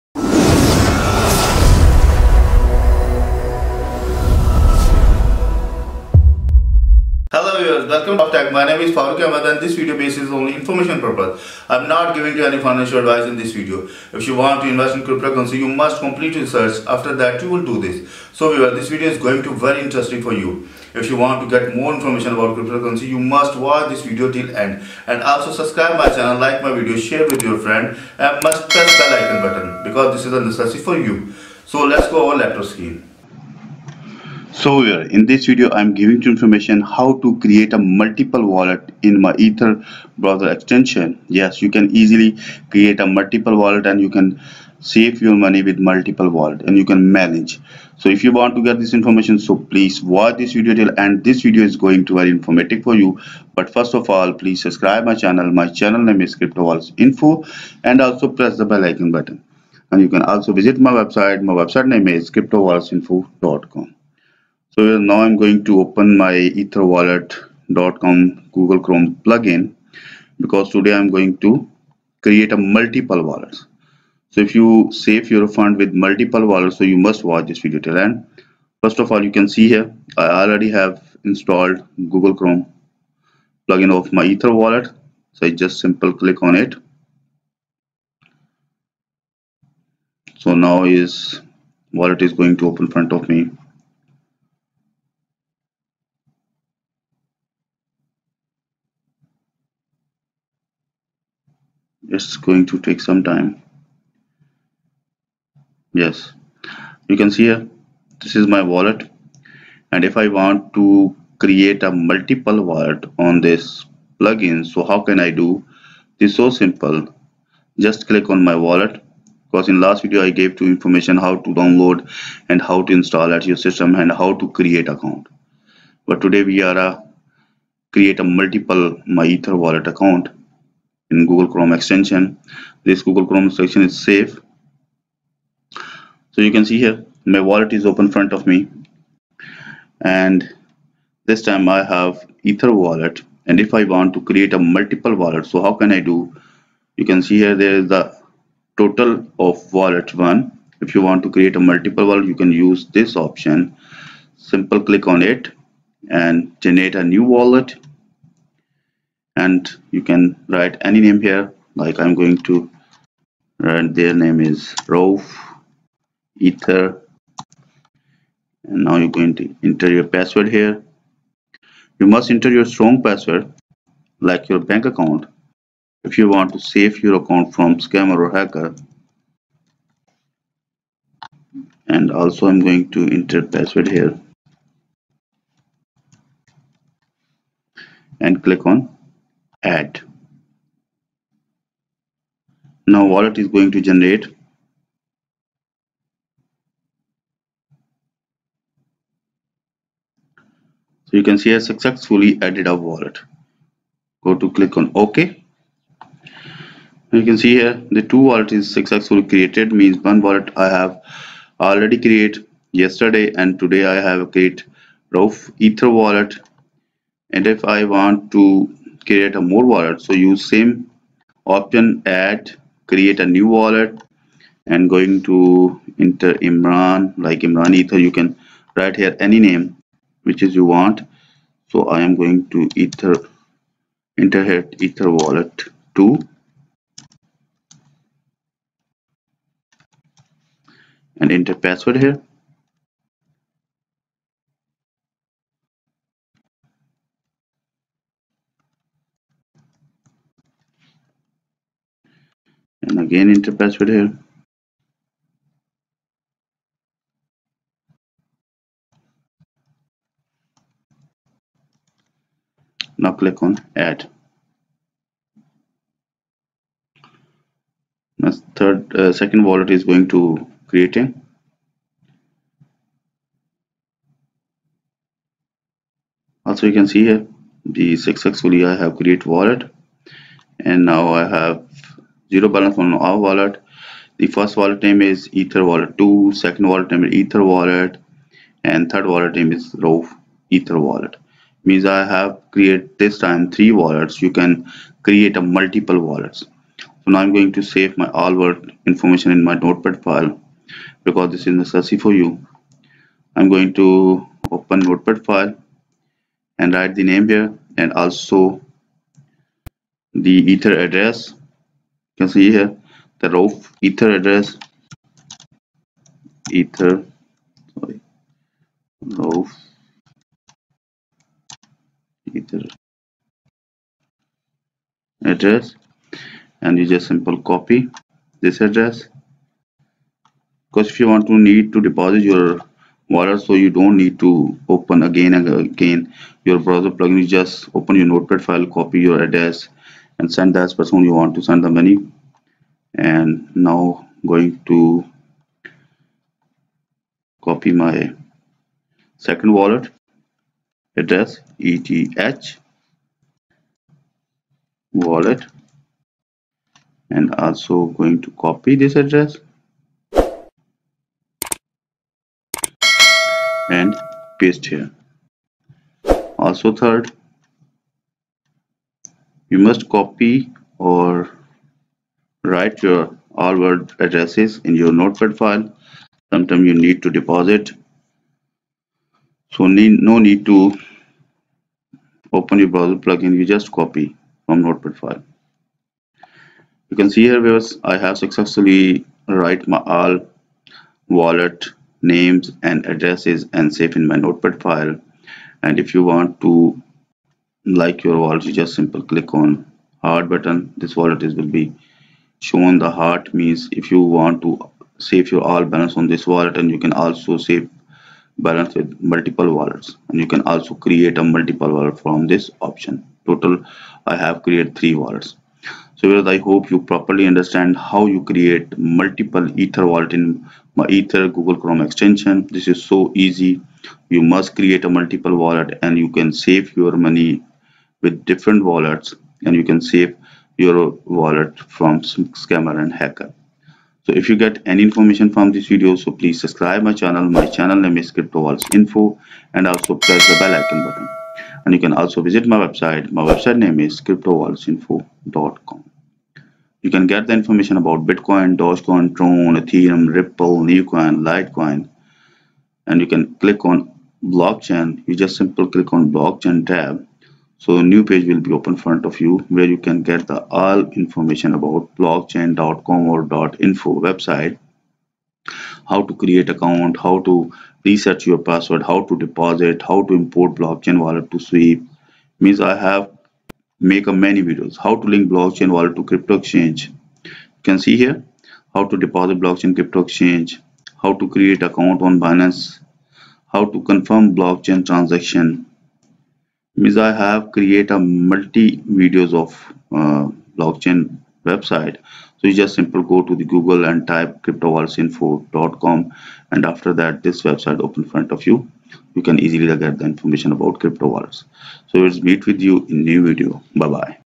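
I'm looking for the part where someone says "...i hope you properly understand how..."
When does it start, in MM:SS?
06:56.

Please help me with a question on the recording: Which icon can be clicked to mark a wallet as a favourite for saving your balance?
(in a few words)
heart.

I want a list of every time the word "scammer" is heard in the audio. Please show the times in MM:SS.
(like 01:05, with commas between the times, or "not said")
02:57, 07:12.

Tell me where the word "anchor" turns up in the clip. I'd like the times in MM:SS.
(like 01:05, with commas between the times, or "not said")
not said.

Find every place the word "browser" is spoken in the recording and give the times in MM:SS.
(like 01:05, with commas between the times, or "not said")
00:40, 05:36, 06:22.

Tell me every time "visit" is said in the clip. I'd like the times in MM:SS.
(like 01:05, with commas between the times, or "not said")
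01:00, 07:22.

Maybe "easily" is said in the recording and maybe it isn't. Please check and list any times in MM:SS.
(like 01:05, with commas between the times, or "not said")
00:41, 08:19.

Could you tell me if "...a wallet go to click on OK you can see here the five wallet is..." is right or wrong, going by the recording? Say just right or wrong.
wrong.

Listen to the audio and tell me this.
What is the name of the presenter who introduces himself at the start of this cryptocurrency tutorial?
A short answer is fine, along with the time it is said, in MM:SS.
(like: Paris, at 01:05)
Farooq Ahmed, at 00:08.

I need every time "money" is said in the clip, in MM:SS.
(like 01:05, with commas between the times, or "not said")
00:45, 05:41, 07:07.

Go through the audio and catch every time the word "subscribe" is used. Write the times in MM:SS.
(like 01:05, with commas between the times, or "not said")
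00:25, 00:54, 07:16.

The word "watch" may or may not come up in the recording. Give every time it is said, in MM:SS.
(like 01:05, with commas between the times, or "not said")
00:23, 00:50, 01:17.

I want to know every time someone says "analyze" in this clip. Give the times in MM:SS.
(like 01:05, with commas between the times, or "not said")
not said.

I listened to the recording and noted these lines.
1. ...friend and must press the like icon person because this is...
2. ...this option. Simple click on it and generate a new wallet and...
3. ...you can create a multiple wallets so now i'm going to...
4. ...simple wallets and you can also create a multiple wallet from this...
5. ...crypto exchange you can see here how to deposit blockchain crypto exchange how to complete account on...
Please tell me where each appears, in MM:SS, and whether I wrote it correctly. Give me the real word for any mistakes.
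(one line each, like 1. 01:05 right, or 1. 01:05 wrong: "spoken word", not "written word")
1. 00:27 wrong: "button", not "person"
2. 02:32 right
3. 04:54 right
4. 06:49 wrong: "multiple", not "simple"
5. 07:56 wrong: "create", not "complete".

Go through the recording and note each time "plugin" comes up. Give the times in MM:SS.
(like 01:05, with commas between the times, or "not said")
01:09, 01:23, 01:54, 05:36, 06:22.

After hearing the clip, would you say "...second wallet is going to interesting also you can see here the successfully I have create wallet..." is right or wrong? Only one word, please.
wrong.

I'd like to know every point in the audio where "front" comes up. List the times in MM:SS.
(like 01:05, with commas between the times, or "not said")
01:32, 02:18, 07:38, 08:18.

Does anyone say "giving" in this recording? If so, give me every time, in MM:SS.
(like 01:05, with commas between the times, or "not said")
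00:12, 00:35.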